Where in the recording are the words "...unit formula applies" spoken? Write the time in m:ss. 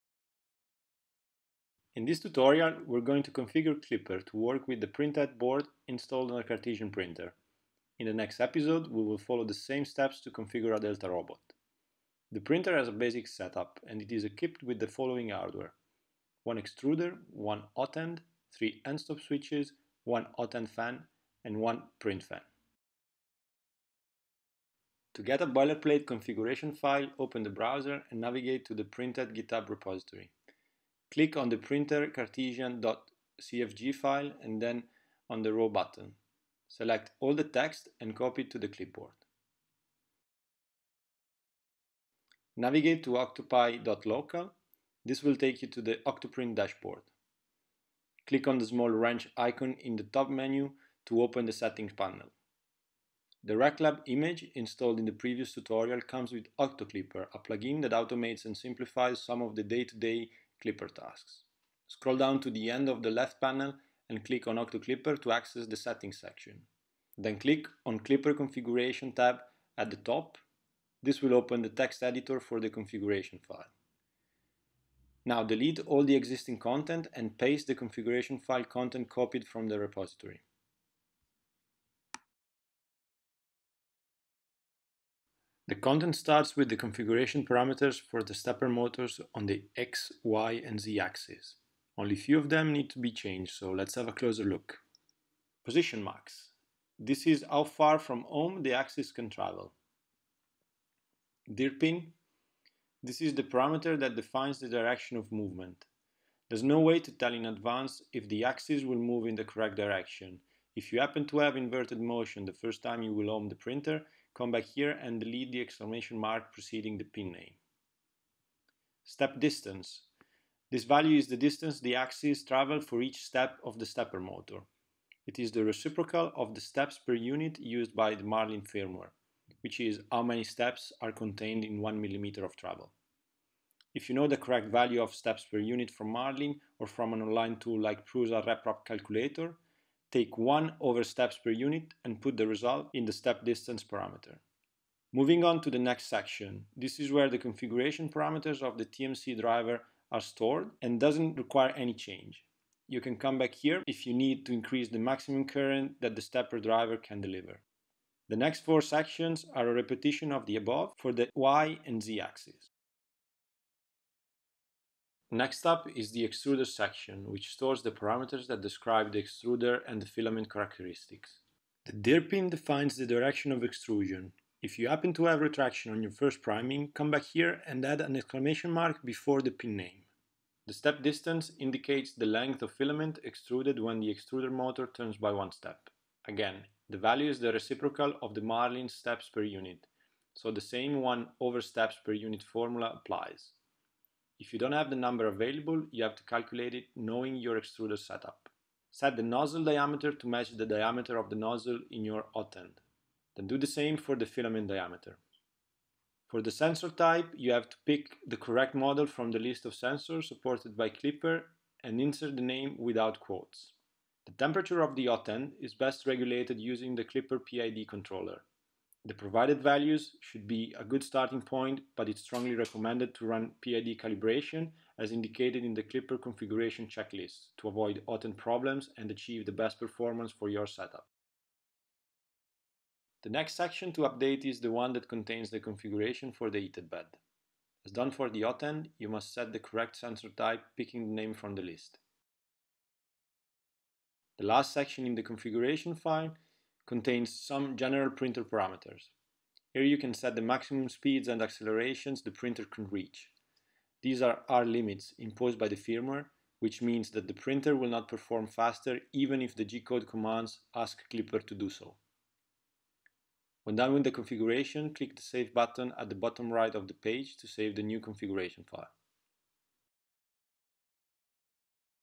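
3:12.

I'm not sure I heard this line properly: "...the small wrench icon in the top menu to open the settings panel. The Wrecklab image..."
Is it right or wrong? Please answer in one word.
right.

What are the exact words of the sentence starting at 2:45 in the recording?
Next up is the extruder section, which stores the parameters that describe the extruder and the filament characteristics.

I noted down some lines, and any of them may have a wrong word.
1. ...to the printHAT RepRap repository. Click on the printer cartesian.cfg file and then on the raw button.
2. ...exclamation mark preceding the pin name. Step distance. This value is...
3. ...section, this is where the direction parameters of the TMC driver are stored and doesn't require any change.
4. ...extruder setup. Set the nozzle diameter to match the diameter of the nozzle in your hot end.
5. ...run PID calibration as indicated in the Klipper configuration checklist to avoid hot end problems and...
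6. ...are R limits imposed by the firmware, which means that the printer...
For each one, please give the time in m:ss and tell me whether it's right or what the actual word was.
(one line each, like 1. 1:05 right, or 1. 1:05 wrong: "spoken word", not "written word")
1. 0:28 wrong: "GitHub", not "RepRap"
2. 1:55 right
3. 2:26 wrong: "configuration", not "direction"
4. 3:17 right
5. 3:43 right
6. 4:14 right.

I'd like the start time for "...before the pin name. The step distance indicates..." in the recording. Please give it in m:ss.
2:59.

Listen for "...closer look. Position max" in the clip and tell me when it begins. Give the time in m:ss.
1:34.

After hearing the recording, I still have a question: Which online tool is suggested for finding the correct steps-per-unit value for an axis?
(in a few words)
Prusa RepRap Calculator.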